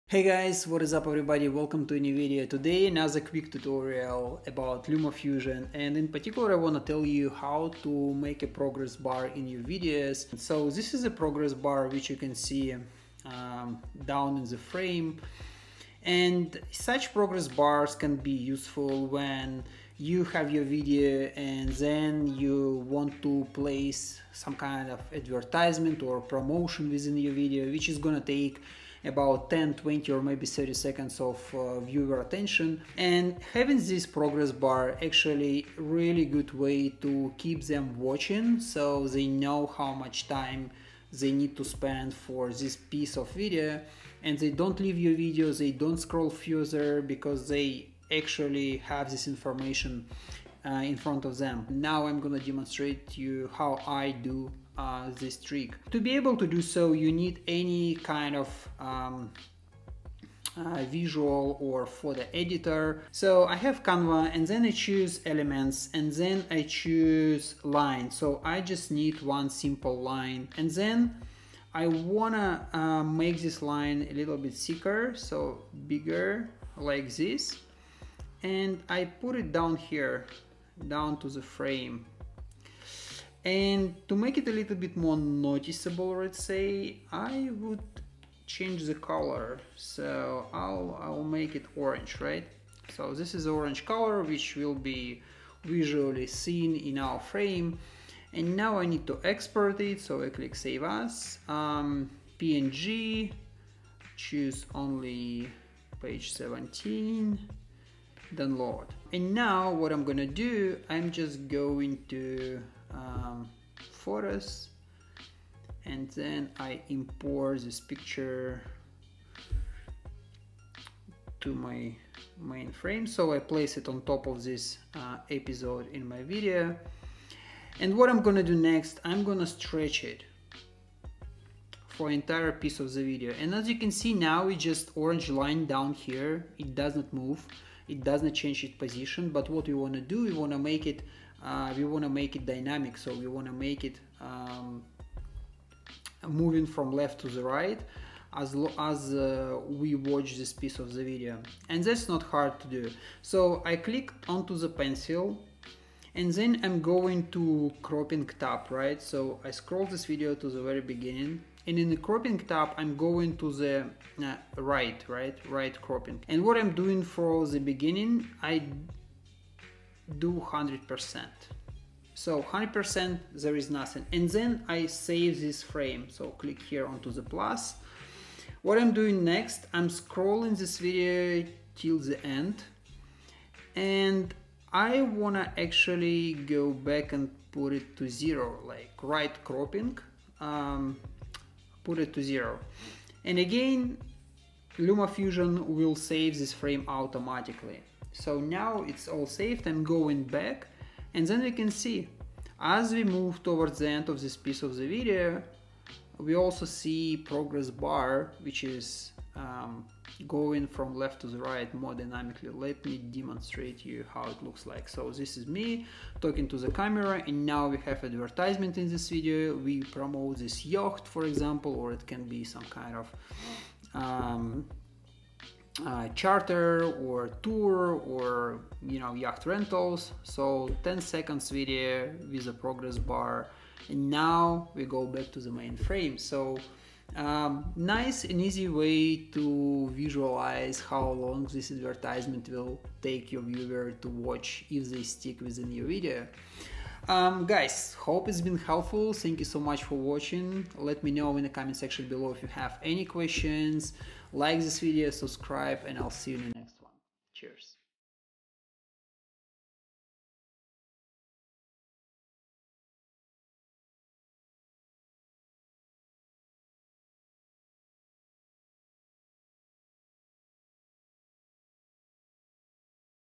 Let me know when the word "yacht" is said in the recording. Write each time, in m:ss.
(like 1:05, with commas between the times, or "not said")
3:40, 3:49.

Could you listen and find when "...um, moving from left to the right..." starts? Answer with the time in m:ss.
2:24.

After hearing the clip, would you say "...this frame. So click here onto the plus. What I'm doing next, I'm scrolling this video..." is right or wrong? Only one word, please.
right.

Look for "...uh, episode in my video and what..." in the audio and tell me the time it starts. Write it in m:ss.
2:04.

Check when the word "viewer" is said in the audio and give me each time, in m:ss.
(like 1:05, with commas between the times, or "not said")
0:31, 4:03.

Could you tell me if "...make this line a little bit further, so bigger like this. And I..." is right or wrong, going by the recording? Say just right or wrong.
wrong.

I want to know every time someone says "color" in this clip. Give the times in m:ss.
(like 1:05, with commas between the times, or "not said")
1:28, 1:33.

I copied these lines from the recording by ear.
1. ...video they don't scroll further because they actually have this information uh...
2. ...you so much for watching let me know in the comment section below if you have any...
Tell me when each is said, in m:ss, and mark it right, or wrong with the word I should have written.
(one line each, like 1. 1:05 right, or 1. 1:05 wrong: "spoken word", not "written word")
1. 0:45 right
2. 4:09 right.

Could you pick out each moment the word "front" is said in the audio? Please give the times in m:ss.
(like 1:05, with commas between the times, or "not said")
0:50.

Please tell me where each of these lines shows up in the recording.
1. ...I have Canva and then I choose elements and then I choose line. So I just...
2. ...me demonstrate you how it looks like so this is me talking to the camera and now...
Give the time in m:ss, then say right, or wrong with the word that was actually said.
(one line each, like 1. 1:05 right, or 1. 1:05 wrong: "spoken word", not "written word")
1. 1:03 right
2. 3:32 right.